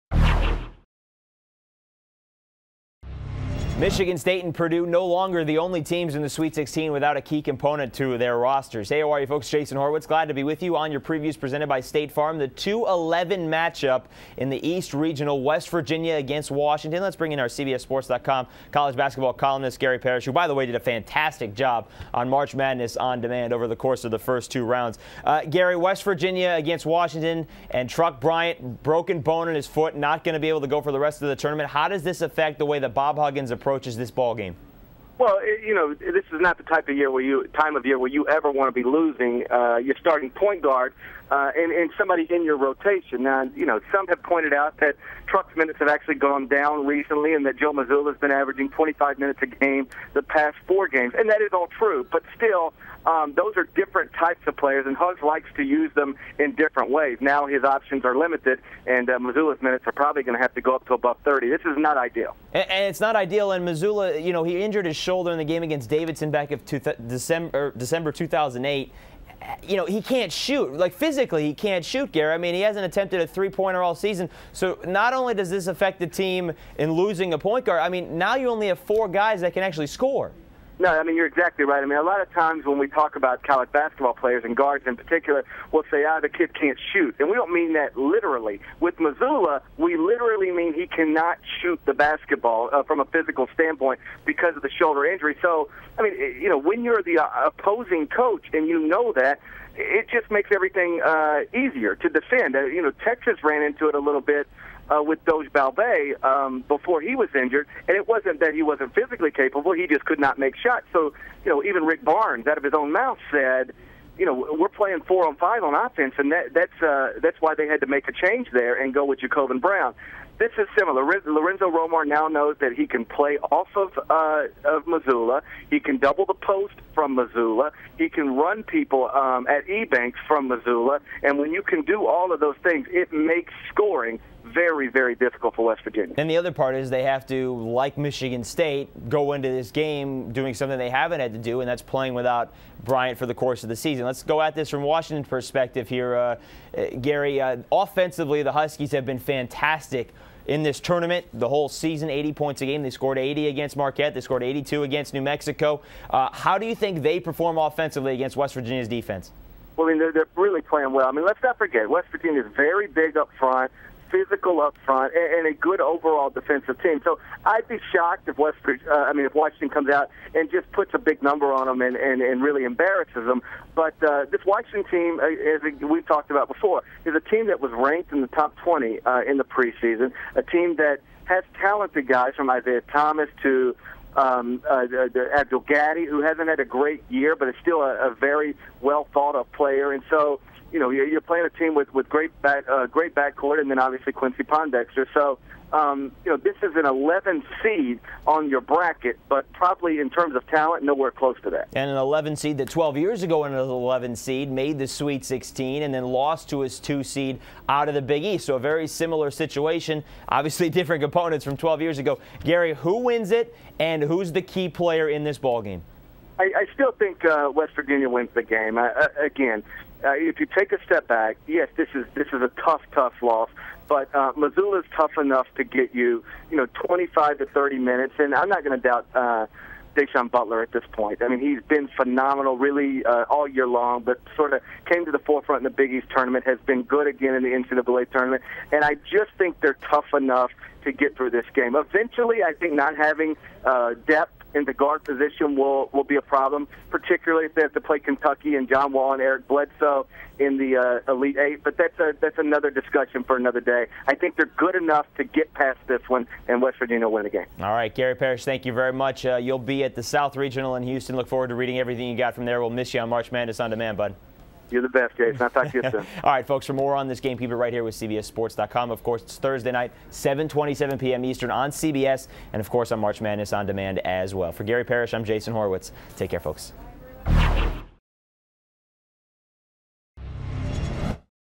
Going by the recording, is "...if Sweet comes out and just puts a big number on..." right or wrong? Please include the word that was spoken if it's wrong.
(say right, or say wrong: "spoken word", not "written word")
wrong: "Washington", not "Sweet".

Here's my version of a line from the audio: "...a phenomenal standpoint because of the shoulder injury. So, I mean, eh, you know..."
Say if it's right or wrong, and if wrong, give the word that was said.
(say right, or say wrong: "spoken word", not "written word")
wrong: "physical", not "phenomenal".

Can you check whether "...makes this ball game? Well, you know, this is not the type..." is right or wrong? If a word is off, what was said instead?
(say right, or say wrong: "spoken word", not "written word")
wrong: "approaches", not "makes".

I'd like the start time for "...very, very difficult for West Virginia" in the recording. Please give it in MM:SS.
02:14.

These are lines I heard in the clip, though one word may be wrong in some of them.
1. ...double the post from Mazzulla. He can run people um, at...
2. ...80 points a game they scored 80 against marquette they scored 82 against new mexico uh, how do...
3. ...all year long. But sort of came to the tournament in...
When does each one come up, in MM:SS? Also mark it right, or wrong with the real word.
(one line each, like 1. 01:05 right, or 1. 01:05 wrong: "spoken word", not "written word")
1. 02:05 right
2. 02:32 right
3. 03:53 wrong: "forefront", not "tournament".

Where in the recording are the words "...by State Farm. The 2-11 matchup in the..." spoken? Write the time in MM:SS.
00:11.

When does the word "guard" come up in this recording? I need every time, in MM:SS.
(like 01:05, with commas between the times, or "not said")
00:40, 01:17, 01:24, 04:04.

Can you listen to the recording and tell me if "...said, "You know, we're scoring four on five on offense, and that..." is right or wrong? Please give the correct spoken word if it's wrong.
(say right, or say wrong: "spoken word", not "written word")
wrong: "playing", not "scoring".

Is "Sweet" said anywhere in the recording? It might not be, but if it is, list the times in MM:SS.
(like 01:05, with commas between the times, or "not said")
00:06, 03:24.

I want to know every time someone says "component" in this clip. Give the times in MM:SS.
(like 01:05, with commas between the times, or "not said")
00:07, 03:31.